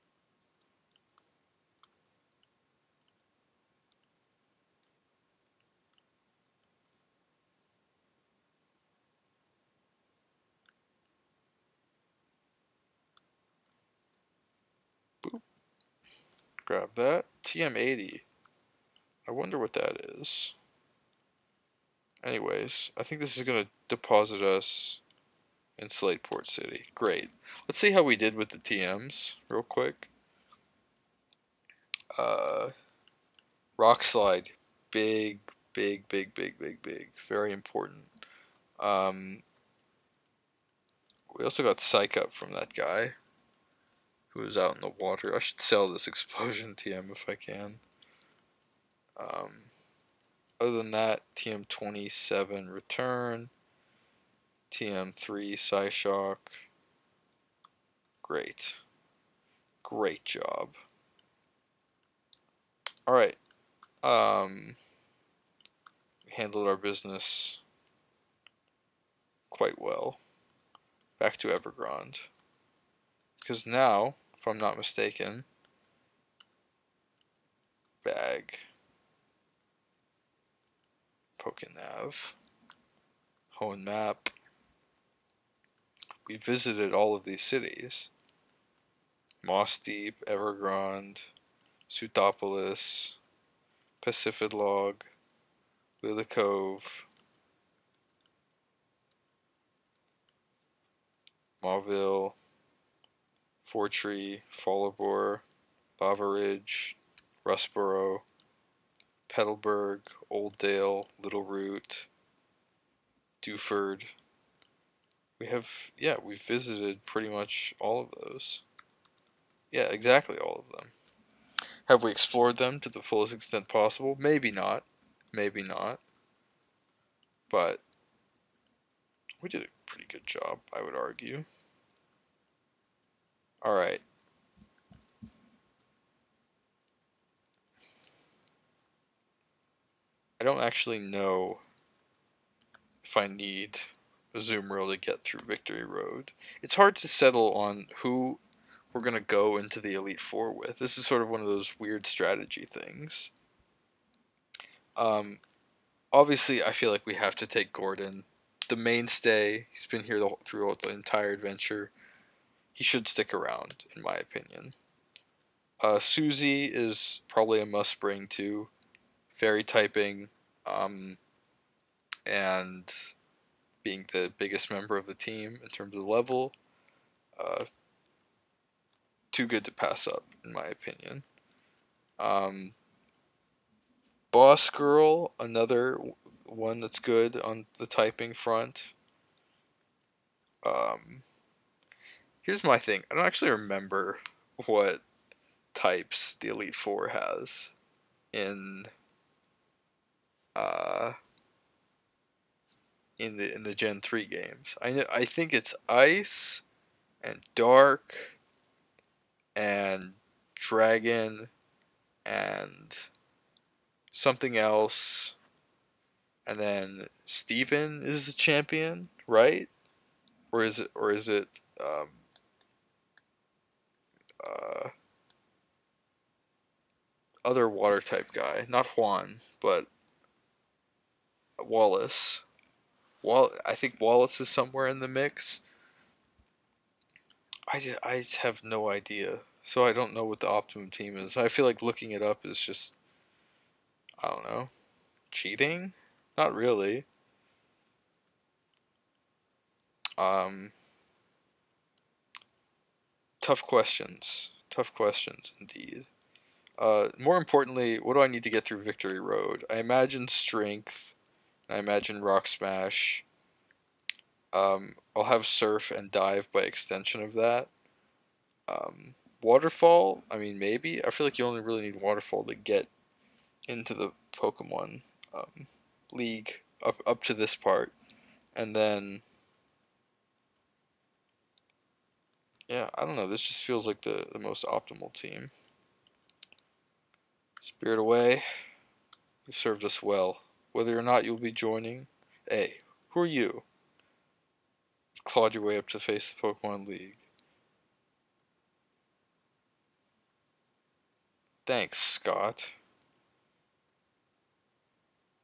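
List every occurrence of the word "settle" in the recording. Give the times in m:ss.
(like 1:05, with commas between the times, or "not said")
2:27.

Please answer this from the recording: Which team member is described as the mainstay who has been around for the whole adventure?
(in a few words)
Gordon.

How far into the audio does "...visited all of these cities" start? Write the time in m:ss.
1:26.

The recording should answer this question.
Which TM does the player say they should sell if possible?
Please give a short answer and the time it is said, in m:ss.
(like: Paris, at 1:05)
Explosion, at 0:46.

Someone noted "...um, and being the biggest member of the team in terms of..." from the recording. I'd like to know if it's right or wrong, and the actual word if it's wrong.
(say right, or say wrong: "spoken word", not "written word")
right.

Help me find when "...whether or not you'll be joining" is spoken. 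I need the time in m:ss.
4:50.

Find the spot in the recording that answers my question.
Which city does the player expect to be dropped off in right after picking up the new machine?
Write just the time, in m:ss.
0:25.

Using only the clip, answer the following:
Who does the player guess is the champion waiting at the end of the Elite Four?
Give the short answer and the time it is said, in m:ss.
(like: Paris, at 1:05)
Steven, at 3:37.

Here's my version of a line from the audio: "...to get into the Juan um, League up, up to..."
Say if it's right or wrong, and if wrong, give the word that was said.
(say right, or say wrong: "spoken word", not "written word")
wrong: "Pokemon", not "Juan".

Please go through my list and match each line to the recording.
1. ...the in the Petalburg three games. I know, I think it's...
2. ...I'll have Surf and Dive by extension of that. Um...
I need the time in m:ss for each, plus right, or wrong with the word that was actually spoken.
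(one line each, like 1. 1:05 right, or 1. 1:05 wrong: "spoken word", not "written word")
1. 3:23 wrong: "Gen", not "Petalburg"
2. 4:25 right.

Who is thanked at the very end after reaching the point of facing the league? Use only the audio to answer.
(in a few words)
Scott.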